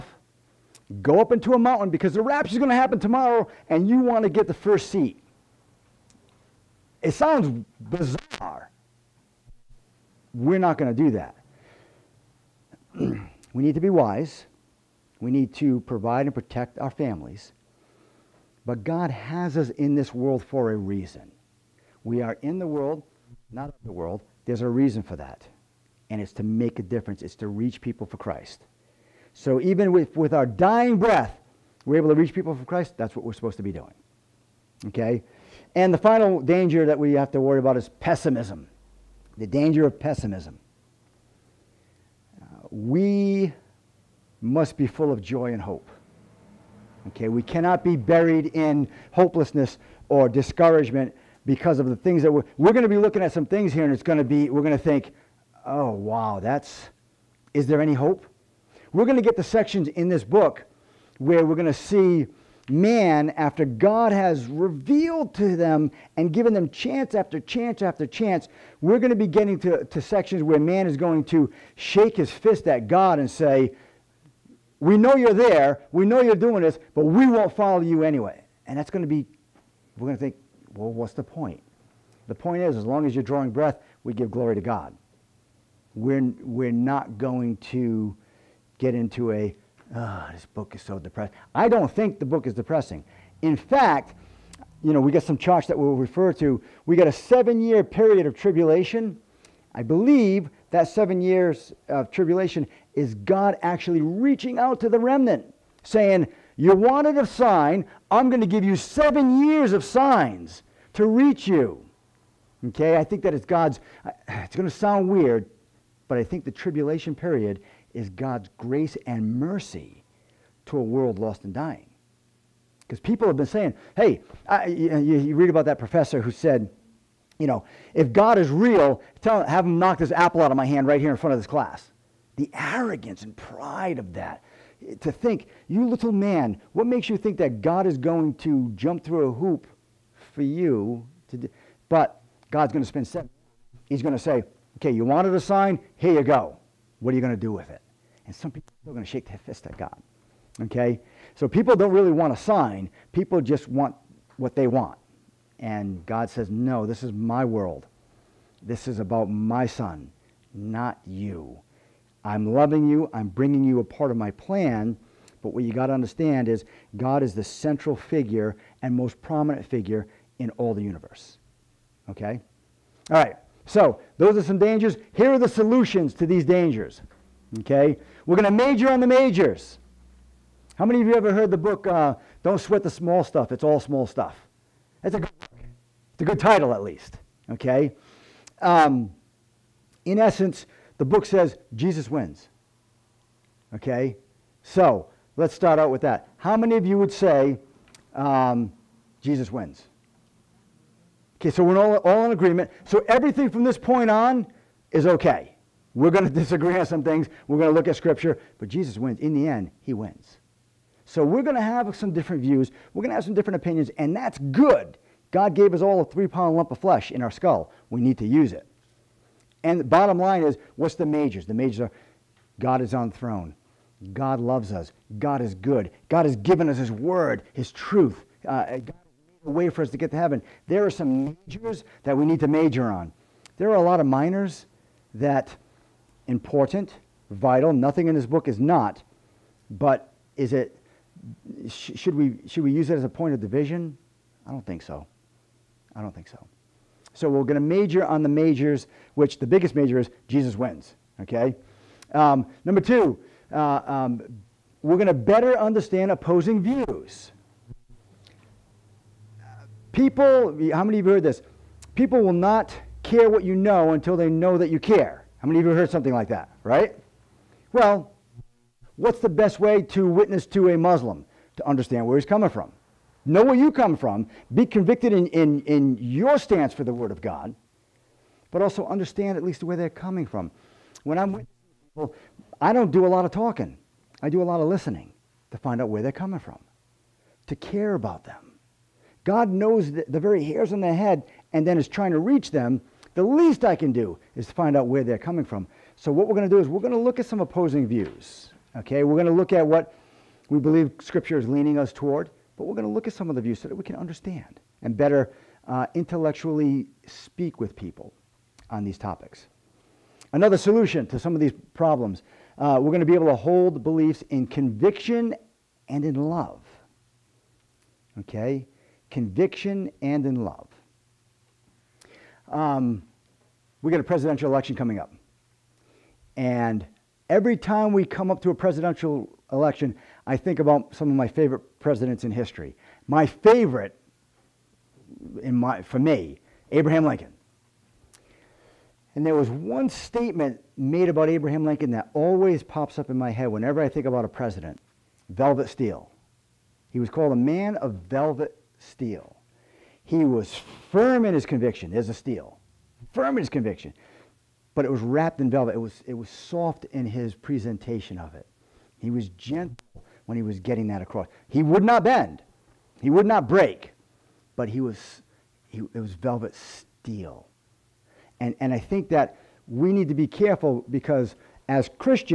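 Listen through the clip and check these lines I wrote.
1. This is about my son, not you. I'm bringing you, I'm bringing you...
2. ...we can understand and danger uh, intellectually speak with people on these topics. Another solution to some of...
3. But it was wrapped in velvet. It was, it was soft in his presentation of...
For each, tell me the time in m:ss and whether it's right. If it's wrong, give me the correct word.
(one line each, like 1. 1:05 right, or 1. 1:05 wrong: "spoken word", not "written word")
1. 2:38 wrong: "loving", not "bringing"
2. 5:03 wrong: "better", not "danger"
3. 5:54 right.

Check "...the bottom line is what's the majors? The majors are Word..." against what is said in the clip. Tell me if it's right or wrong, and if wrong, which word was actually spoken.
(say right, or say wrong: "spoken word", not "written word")
wrong: "God", not "Word".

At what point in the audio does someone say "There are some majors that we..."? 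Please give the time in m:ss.
3:50.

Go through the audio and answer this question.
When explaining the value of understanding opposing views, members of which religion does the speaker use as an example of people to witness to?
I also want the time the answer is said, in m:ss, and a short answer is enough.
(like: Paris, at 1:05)
Muslim, at 4:30.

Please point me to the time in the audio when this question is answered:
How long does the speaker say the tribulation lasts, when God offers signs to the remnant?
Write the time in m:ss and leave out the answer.
1:37.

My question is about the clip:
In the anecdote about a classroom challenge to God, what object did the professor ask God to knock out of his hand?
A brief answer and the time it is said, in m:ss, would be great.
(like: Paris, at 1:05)
Apple, at 2:10.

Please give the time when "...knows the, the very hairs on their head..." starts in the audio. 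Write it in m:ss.
4:49.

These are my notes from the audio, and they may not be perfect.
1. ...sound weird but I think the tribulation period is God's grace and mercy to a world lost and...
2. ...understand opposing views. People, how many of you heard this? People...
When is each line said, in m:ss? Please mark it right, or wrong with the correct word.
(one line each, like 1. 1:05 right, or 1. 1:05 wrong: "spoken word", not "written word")
1. 1:54 right
2. 4:15 right.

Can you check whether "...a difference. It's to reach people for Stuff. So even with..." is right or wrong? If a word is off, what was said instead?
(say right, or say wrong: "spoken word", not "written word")
wrong: "Christ", not "Stuff".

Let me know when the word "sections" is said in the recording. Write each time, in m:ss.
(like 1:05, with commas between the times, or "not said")
0:59, 1:10.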